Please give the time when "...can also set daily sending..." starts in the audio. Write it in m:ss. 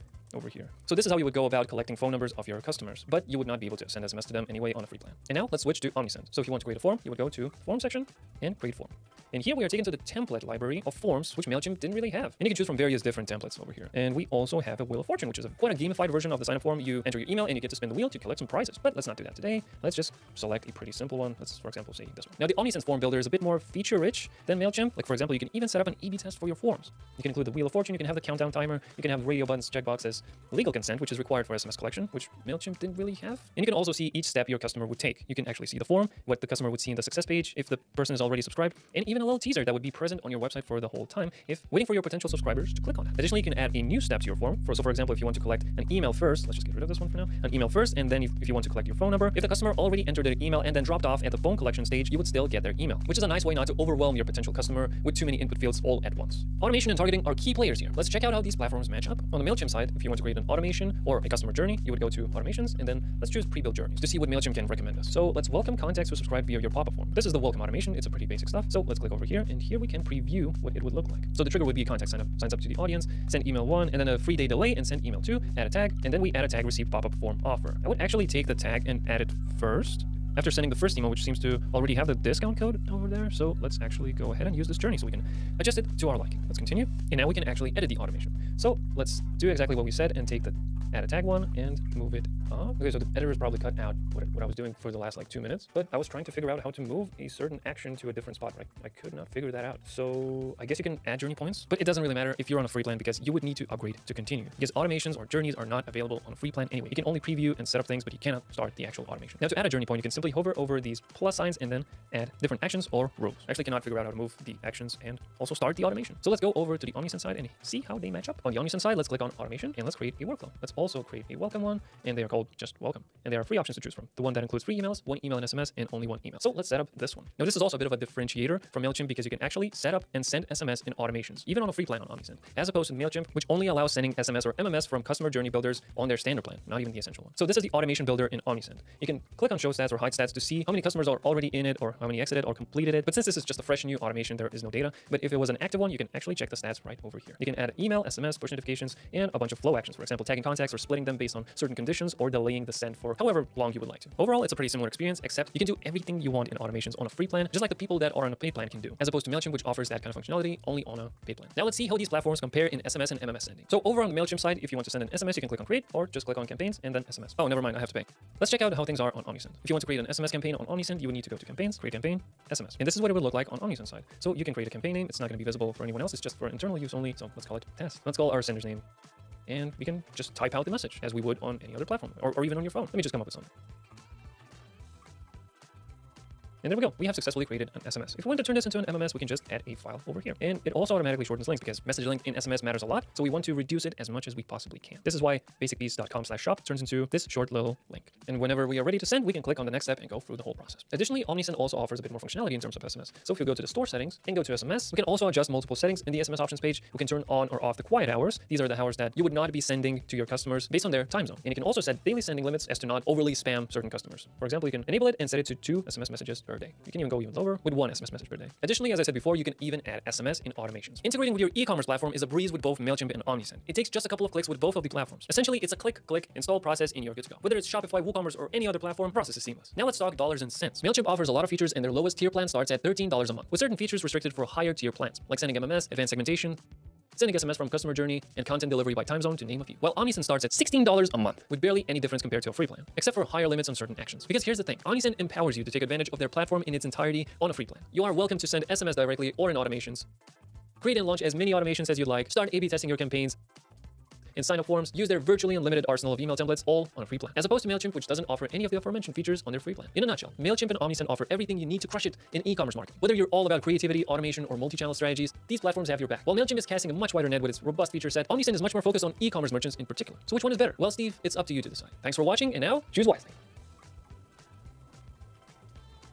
3:31.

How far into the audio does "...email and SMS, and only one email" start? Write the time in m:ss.
2:05.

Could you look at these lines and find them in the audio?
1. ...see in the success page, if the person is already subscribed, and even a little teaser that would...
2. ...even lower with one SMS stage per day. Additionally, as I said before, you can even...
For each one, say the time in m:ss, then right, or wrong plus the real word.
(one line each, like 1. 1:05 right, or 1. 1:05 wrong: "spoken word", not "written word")
1. 0:36 right
2. 3:37 wrong: "message", not "stage".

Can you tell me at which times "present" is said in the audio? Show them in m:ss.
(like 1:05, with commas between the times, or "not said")
0:39.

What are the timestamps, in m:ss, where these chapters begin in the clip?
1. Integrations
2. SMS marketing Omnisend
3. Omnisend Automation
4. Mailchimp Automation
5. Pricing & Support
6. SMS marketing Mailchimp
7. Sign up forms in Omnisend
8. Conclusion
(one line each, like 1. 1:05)
1. 3:41
2. 2:49
3. 1:58
4. 0:56
5. 3:49
6. 2:43
7. 0:05
8. 4:19.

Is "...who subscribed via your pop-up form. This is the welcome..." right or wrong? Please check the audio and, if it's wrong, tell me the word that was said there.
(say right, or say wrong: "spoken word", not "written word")
right.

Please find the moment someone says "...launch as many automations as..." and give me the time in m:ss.
4:11.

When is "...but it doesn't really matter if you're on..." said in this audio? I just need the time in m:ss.
1:41.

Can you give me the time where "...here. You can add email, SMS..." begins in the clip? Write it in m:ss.
2:27.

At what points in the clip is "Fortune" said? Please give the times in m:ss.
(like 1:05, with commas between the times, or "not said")
0:15, 0:27.